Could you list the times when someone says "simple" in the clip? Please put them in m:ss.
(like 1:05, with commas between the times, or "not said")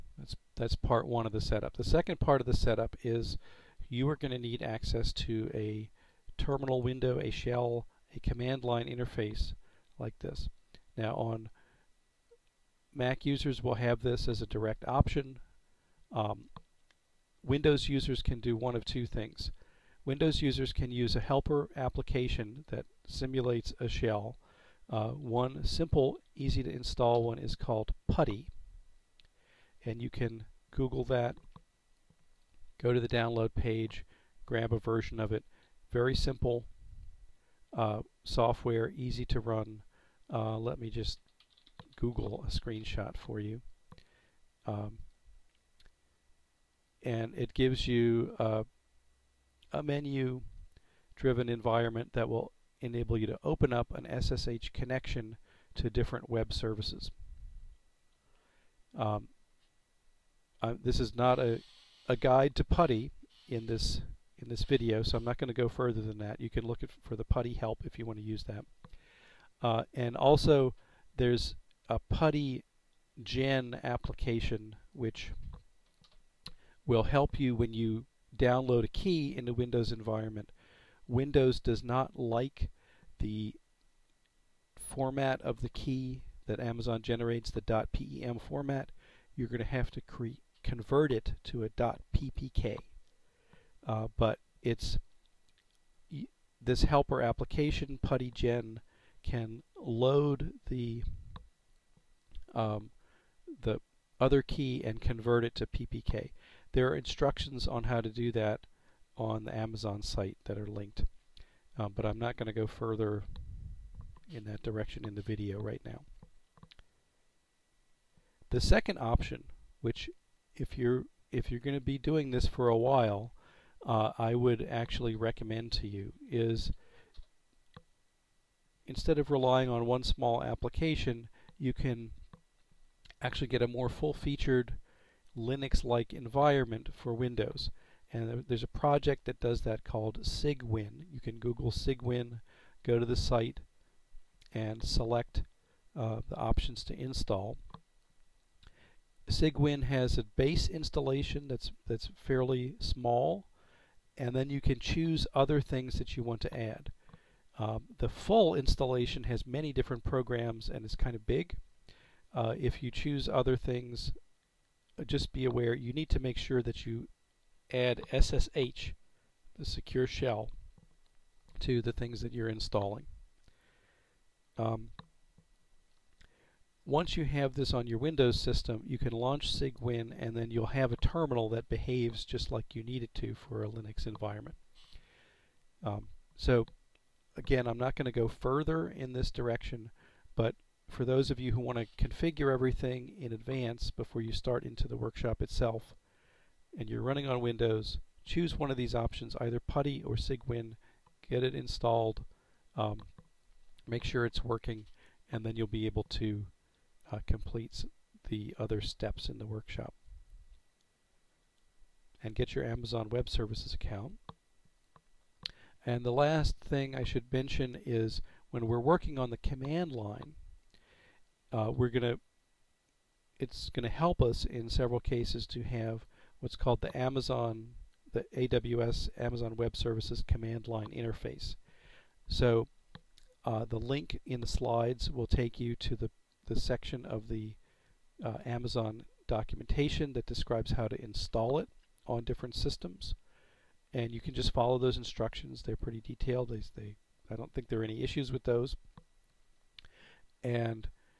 0:25, 0:36.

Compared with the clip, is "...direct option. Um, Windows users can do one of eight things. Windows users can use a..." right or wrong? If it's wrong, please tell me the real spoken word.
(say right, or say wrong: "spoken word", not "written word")
wrong: "two", not "eight".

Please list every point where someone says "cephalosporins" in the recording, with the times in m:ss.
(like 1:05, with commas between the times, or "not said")
not said.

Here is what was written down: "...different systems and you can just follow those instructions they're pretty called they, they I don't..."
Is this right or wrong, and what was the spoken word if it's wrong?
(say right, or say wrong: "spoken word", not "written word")
wrong: "detailed", not "called".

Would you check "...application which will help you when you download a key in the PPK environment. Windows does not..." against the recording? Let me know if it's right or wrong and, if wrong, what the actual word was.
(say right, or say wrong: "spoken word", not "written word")
wrong: "Windows", not "PPK".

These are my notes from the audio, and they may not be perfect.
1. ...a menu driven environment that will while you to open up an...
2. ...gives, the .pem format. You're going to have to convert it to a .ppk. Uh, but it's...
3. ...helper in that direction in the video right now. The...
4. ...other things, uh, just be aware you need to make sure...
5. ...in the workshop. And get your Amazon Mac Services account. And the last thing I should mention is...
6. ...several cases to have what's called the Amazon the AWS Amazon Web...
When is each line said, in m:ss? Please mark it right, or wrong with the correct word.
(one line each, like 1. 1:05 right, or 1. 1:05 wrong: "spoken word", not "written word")
1. 0:48 wrong: "enable", not "while"
2. 1:27 wrong: "generates", not "gives"
3. 1:52 wrong: "further", not "helper"
4. 2:43 right
5. 3:29 wrong: "Web", not "Mac"
6. 3:44 right.